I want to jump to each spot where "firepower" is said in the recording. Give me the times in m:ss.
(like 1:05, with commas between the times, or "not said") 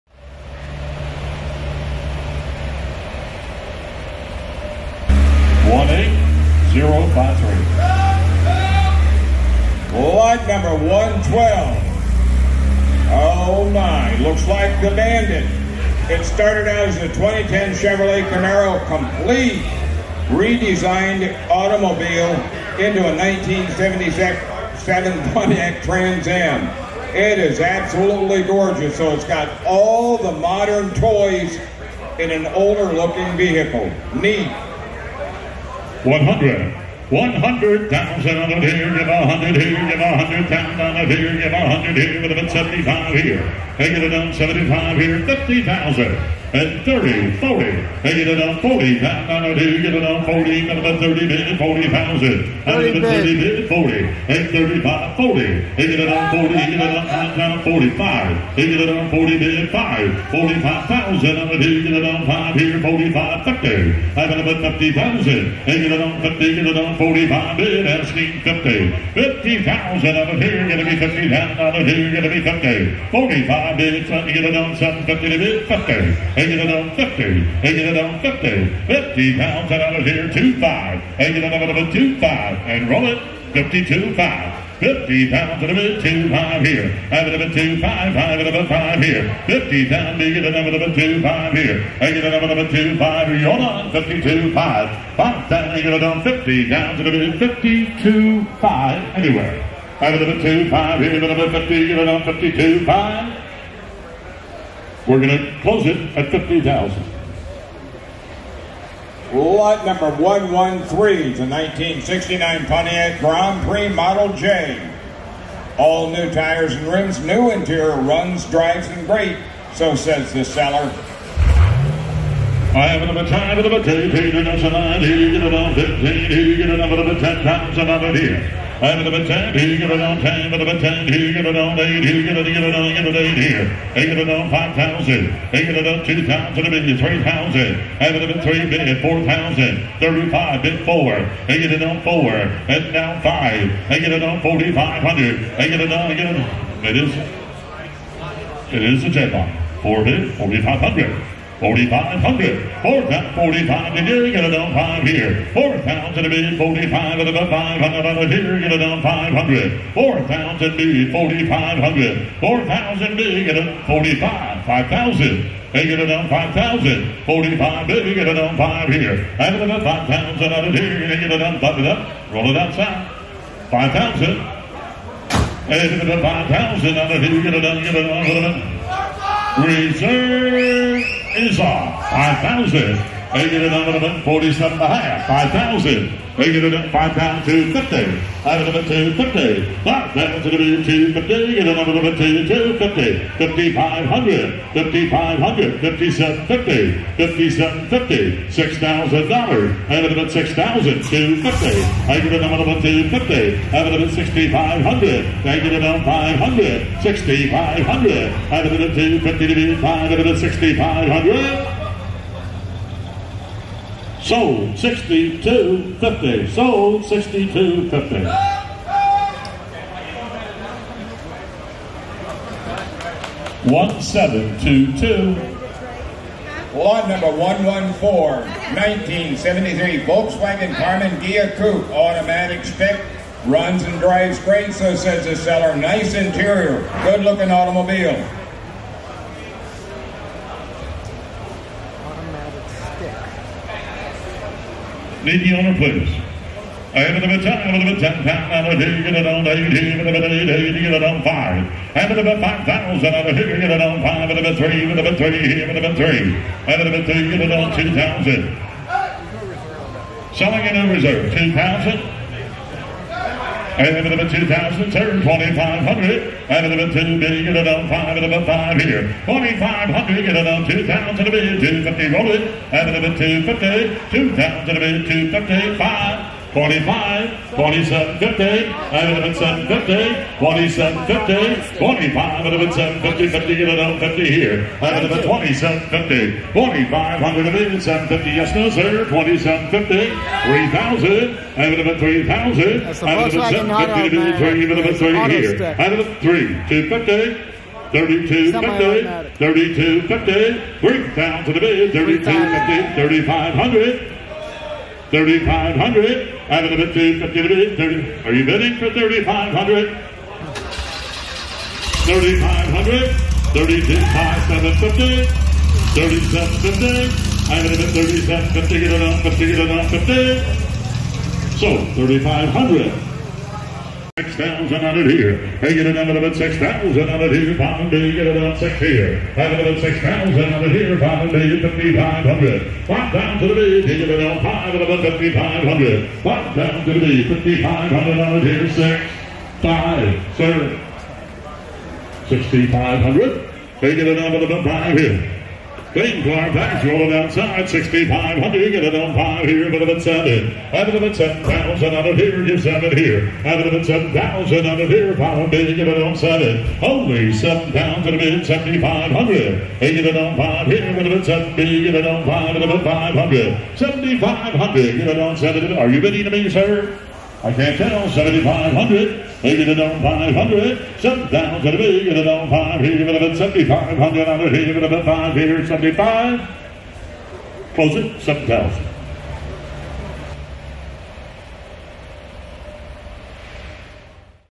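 not said.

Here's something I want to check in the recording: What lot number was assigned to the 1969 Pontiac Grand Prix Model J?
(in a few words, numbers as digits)
113.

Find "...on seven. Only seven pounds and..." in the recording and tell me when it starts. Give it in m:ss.
5:56.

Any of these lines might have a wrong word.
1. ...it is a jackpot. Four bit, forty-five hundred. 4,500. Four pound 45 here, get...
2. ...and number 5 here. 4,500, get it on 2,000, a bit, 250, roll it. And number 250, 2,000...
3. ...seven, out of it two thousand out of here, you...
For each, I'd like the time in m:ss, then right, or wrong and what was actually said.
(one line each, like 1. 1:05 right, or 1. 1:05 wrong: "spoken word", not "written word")
1. 2:28 right
2. 4:28 right
3. 5:50 wrong: "seven", not "two".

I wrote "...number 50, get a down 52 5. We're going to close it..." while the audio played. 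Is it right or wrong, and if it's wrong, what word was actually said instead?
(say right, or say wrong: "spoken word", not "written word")
right.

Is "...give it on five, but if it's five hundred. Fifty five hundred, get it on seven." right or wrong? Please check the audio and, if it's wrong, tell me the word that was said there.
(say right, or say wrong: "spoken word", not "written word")
wrong: "Seventy", not "Fifty".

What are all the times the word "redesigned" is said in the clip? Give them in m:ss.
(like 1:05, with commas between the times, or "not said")
0:20.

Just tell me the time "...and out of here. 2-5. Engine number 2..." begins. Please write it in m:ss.
1:19.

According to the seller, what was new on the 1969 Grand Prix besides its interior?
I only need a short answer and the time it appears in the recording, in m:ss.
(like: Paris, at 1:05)
Tires and rims, at 1:55.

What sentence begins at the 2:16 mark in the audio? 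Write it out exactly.
times and a bit, three thousand.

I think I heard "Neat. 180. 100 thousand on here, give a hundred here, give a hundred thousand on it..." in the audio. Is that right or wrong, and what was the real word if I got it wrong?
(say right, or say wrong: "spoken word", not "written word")
wrong: "100", not "180".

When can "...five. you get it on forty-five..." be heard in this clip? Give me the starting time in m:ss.
2:23.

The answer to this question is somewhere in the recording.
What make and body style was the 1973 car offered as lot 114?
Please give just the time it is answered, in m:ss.
3:50.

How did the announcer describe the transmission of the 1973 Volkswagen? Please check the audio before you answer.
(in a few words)
Automatic stick.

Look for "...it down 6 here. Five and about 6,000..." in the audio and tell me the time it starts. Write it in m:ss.
5:28.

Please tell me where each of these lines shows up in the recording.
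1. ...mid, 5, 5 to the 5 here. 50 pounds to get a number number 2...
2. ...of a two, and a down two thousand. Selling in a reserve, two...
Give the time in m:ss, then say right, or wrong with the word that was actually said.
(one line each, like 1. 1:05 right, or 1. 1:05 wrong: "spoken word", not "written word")
1. 1:27 right
2. 4:16 right.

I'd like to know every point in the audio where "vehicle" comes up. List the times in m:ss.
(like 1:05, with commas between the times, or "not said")
0:33.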